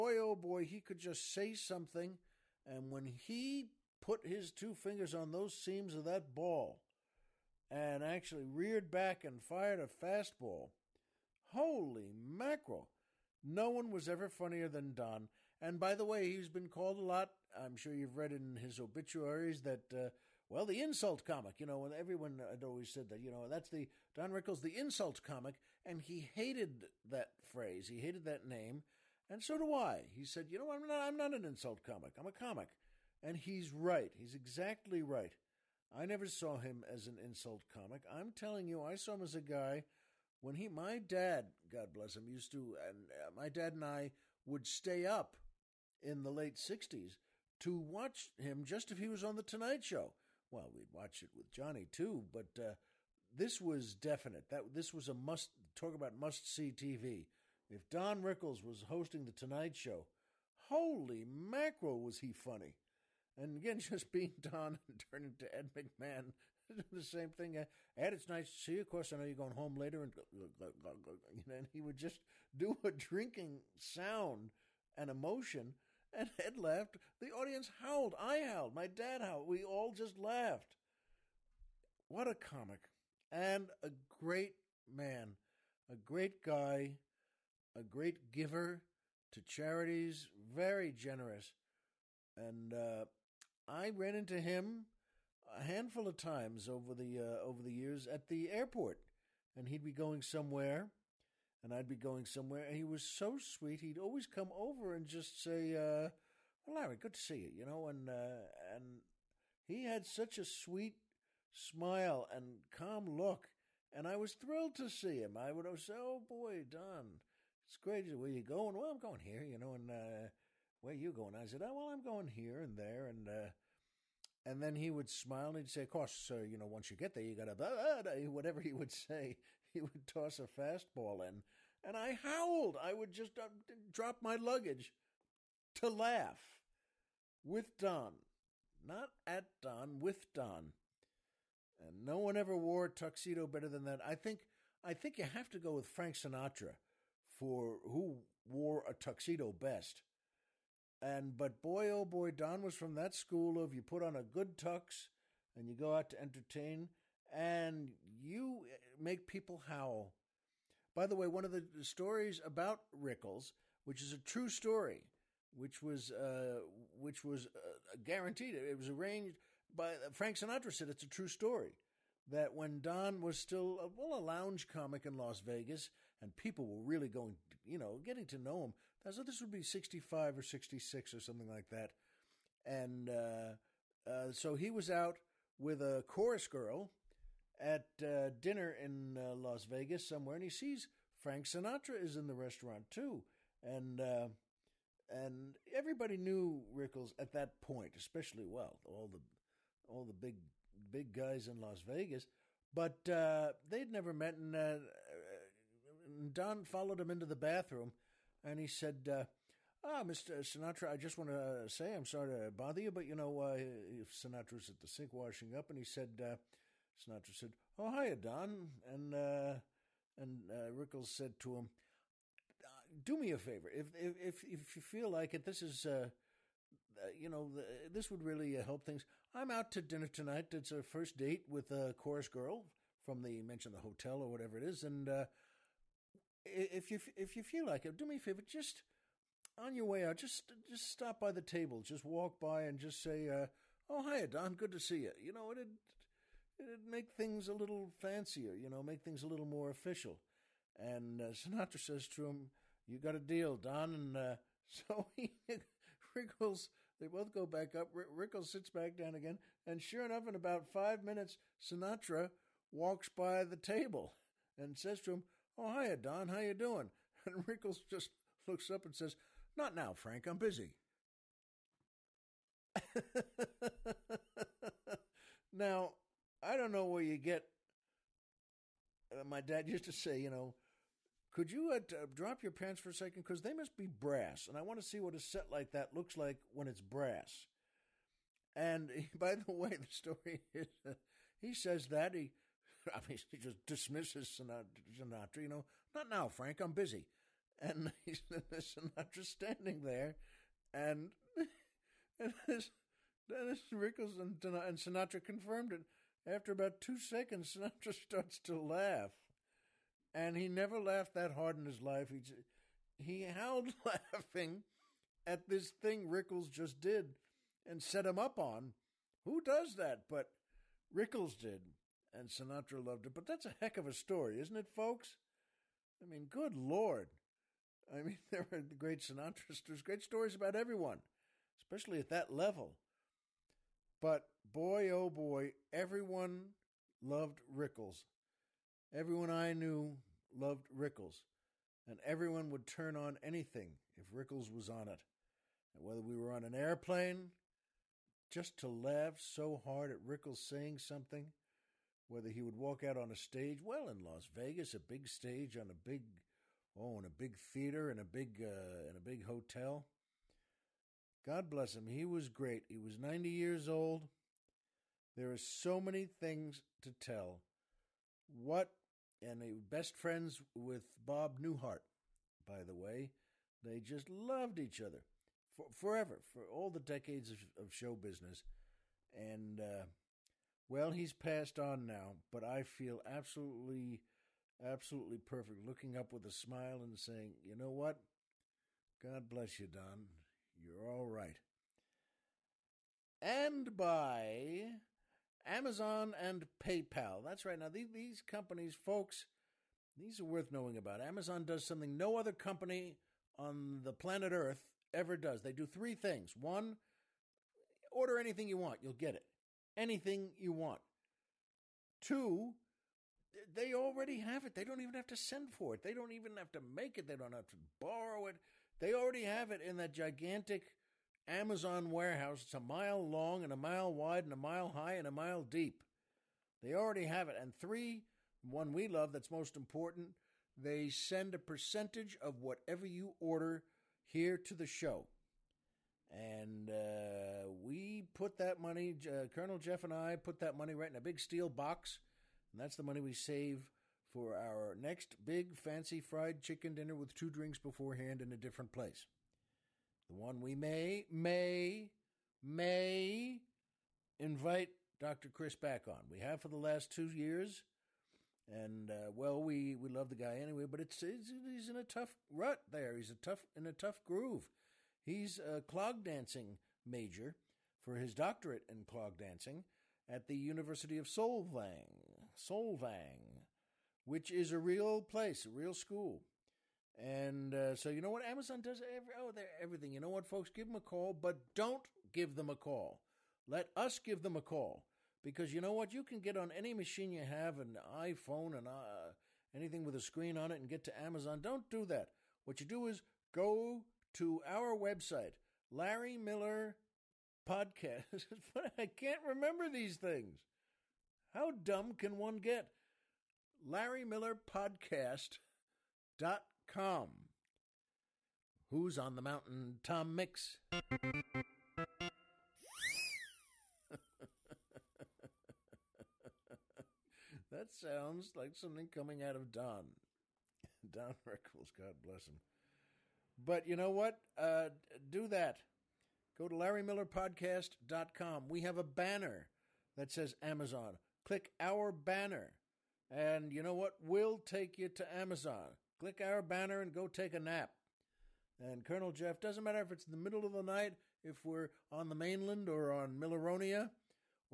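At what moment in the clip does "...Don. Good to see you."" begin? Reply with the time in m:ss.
4:04.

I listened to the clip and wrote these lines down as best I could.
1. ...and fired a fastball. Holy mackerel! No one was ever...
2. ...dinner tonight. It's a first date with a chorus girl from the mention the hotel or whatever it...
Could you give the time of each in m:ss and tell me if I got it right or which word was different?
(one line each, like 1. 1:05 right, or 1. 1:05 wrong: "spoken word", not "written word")
1. 0:09 right
2. 3:49 right.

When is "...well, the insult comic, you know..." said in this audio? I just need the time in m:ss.
0:20.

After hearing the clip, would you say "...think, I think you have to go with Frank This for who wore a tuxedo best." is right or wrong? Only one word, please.
wrong.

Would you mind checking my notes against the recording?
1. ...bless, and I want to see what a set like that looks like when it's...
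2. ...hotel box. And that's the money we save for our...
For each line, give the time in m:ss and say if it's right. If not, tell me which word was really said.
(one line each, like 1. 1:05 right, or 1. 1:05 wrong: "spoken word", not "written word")
1. 4:43 wrong: "brass", not "bless"
2. 7:21 wrong: "steel", not "hotel".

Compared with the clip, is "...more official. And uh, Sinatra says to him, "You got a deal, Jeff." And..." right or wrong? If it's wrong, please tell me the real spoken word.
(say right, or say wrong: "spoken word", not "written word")
wrong: "Don", not "Jeff".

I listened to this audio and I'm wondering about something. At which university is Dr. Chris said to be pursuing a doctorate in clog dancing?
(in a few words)
University of Solvang.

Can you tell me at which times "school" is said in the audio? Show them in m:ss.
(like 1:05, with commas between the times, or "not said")
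2:33, 7:55.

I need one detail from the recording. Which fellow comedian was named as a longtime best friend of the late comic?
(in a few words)
Bob Newhart.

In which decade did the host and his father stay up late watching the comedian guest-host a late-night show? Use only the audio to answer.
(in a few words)
late 60s.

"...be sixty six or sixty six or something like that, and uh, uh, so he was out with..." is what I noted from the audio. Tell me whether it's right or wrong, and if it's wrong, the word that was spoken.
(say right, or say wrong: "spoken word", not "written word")
wrong: "five", not "six".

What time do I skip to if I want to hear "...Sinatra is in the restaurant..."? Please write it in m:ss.
3:11.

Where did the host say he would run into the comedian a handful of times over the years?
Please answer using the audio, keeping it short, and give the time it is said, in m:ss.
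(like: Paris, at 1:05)
the airport, at 1:38.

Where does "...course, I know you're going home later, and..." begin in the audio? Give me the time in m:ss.
1:08.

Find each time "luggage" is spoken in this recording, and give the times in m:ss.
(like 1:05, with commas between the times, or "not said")
2:14.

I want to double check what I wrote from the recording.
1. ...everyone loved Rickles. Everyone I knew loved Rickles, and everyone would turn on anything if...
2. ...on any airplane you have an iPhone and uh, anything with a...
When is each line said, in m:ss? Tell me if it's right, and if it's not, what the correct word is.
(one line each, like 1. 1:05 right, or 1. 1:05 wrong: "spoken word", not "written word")
1. 5:35 right
2. 8:06 wrong: "machine", not "airplane".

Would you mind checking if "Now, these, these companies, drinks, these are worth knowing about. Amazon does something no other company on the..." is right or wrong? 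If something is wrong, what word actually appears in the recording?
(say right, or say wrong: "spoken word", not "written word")
wrong: "folks", not "drinks".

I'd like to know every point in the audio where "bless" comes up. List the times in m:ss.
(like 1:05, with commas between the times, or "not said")
0:41, 6:01, 6:29, 8:42.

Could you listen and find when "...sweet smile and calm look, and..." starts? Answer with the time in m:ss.
1:50.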